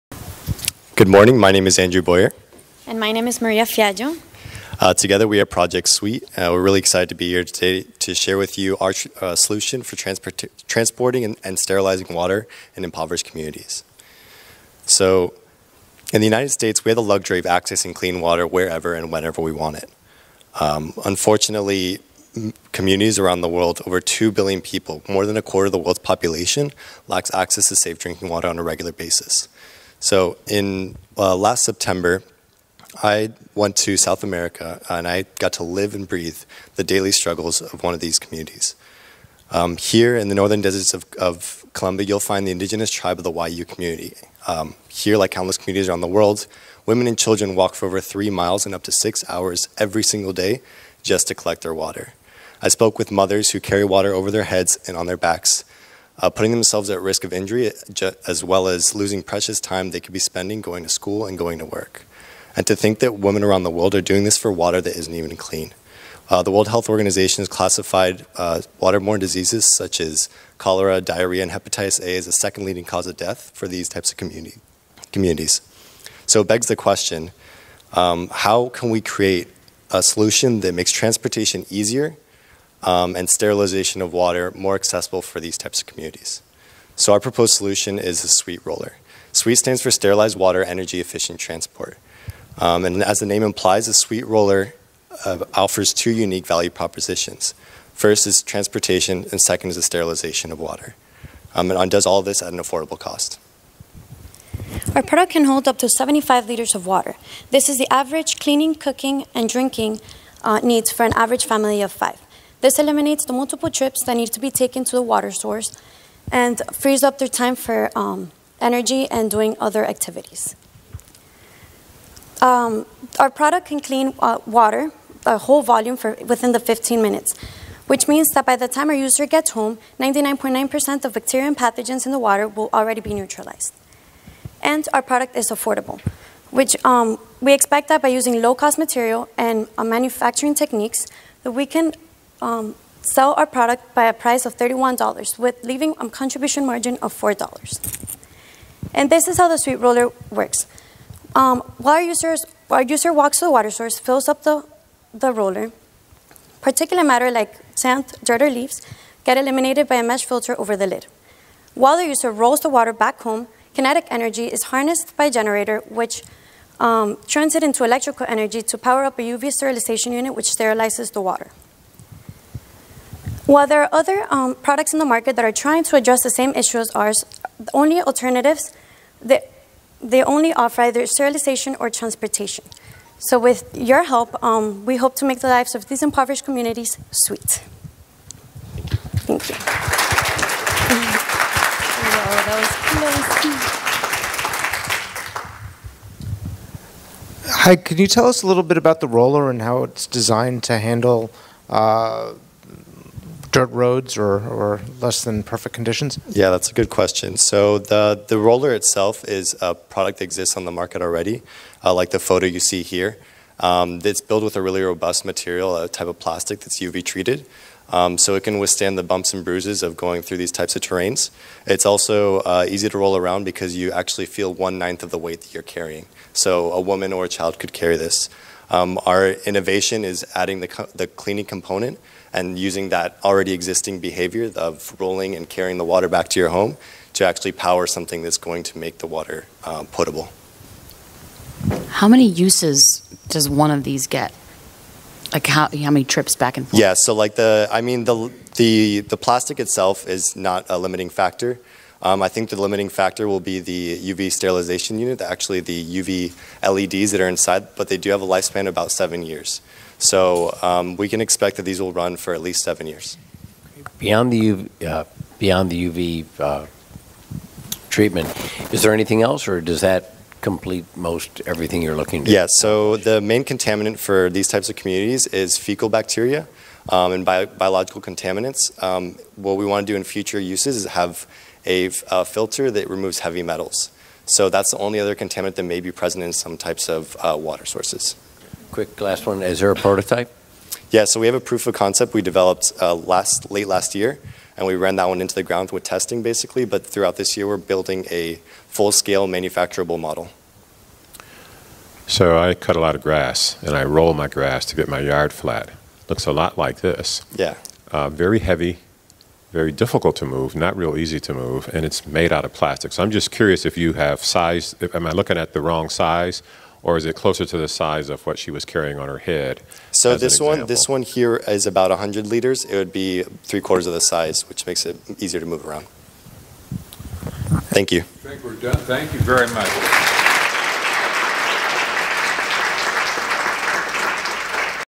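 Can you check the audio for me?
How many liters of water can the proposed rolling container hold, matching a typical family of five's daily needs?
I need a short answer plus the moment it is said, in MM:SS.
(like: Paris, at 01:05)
75, at 01:45.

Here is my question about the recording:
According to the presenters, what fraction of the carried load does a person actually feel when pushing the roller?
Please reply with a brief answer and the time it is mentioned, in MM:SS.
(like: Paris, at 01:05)
One ninth, at 03:44.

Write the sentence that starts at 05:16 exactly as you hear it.
Or is it closer to the size of what she was carrying on her head?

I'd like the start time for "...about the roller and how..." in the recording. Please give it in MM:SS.
03:18.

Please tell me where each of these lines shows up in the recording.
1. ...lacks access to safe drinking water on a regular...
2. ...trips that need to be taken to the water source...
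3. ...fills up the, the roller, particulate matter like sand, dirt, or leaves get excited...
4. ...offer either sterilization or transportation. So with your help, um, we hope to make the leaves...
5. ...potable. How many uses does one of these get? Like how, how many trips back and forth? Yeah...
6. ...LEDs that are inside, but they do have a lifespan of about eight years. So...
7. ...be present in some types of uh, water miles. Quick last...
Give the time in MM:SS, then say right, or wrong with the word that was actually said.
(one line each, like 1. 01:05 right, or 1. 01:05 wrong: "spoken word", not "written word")
1. 00:27 right
2. 01:53 right
3. 02:33 wrong: "eliminated", not "excited"
4. 03:00 wrong: "lives", not "leaves"
5. 03:59 right
6. 04:16 wrong: "seven", not "eight"
7. 04:45 wrong: "sources", not "miles".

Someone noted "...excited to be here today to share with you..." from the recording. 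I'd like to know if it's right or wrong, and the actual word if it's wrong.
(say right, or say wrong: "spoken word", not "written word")
right.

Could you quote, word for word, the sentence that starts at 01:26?
So our proposed solution is the SWEET roller.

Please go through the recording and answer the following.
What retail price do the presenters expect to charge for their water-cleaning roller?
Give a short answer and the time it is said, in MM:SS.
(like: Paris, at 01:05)
$31, at 02:24.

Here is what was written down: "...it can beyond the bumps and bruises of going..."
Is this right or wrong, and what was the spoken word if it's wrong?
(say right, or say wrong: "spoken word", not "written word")
wrong: "withstand", not "beyond".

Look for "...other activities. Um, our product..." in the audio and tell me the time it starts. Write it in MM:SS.
01:59.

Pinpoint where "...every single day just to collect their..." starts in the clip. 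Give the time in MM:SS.
00:49.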